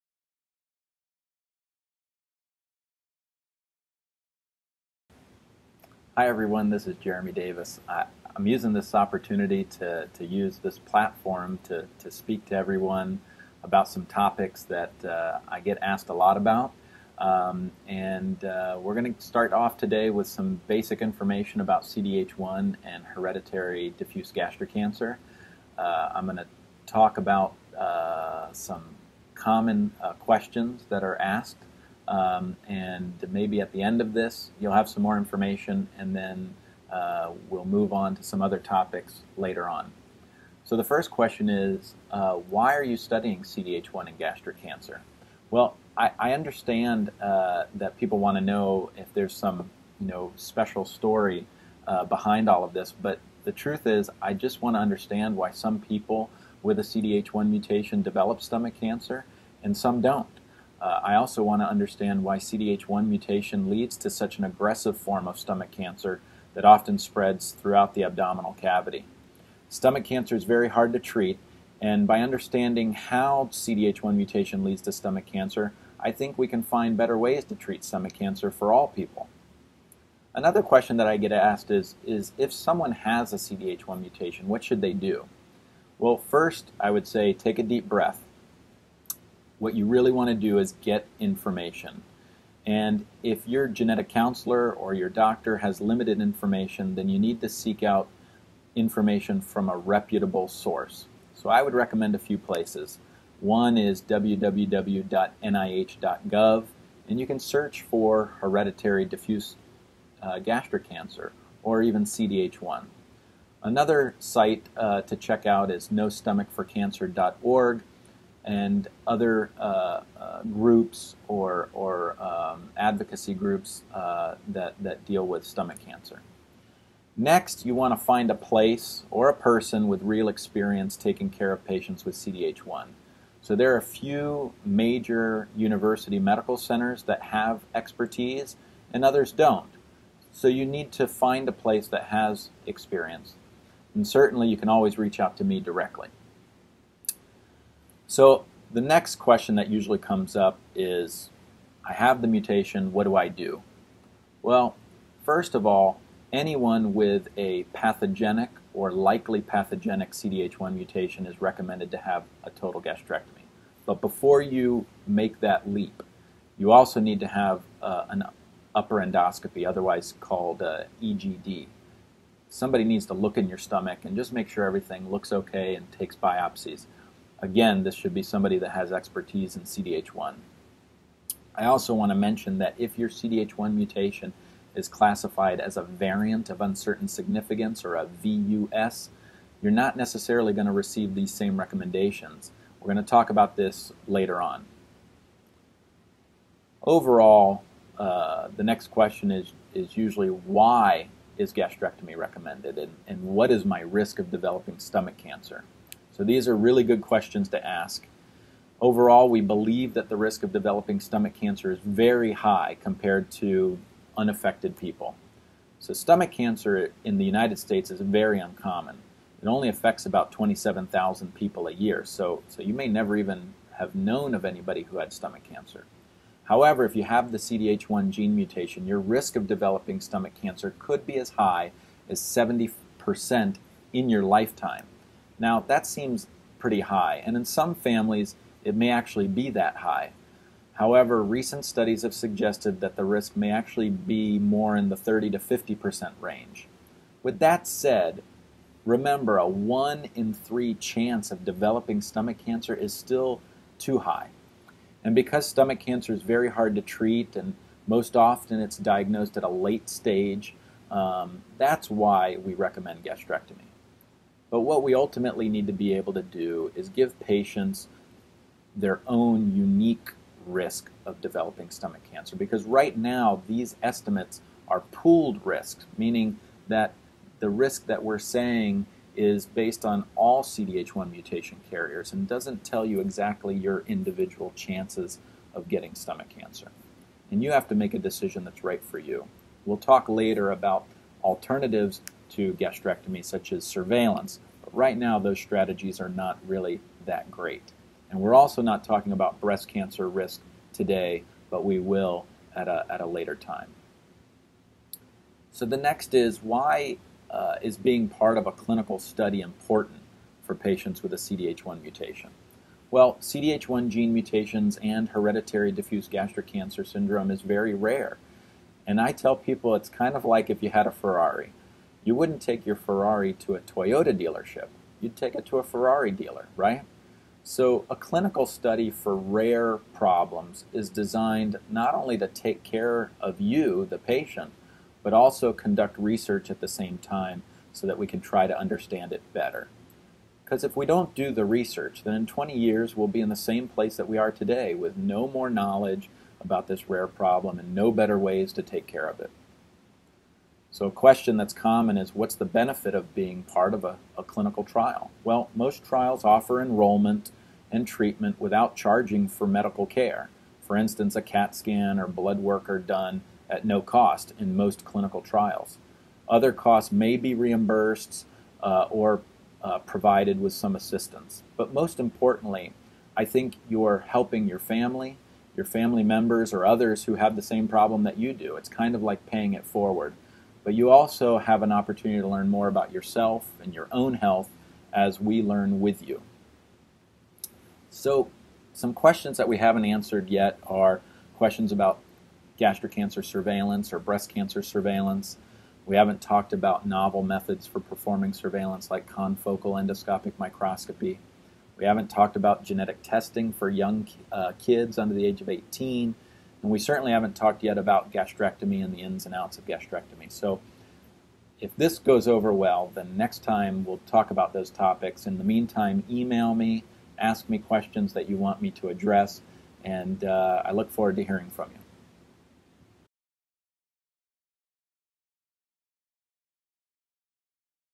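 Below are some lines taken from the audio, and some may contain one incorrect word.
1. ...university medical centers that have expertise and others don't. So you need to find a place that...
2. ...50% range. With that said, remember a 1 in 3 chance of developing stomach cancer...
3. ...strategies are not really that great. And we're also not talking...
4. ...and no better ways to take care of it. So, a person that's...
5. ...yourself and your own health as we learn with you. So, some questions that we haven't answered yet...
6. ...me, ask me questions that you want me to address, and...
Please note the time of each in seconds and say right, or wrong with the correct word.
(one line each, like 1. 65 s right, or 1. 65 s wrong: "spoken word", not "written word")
1. 135 s right
2. 245 s right
3. 295 s right
4. 347 s wrong: "question", not "person"
5. 382 s right
6. 416 s right.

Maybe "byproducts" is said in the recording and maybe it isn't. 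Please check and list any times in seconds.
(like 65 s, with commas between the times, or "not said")
not said.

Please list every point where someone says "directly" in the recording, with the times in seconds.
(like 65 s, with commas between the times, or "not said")
145 s.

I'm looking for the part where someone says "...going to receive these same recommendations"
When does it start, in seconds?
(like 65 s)
190 s.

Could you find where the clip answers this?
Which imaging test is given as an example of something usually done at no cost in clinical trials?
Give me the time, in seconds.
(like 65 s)
361 s.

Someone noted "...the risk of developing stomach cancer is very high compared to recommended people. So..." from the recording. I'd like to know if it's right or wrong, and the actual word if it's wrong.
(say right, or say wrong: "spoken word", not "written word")
wrong: "unaffected", not "recommended".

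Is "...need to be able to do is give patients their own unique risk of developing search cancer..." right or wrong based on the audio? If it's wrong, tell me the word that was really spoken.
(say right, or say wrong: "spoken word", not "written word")
wrong: "stomach", not "search".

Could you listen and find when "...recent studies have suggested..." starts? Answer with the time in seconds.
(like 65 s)
241 s.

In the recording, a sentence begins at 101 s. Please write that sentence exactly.
So I would recommend a few places.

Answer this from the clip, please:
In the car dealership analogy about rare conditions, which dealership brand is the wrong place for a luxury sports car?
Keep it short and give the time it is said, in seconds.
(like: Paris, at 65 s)
Toyota, at 323 s.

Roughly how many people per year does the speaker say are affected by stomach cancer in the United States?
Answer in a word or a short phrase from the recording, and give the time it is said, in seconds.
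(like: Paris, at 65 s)
27,000, at 220 s.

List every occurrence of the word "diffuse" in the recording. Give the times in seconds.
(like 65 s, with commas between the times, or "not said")
23 s, 109 s, 315 s.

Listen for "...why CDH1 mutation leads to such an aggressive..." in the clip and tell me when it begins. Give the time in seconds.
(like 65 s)
62 s.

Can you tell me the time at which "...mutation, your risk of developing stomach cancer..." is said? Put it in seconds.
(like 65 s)
228 s.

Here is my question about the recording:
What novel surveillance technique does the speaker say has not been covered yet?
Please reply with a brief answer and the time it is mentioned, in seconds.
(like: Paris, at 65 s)
confocal endoscopic microscopy, at 399 s.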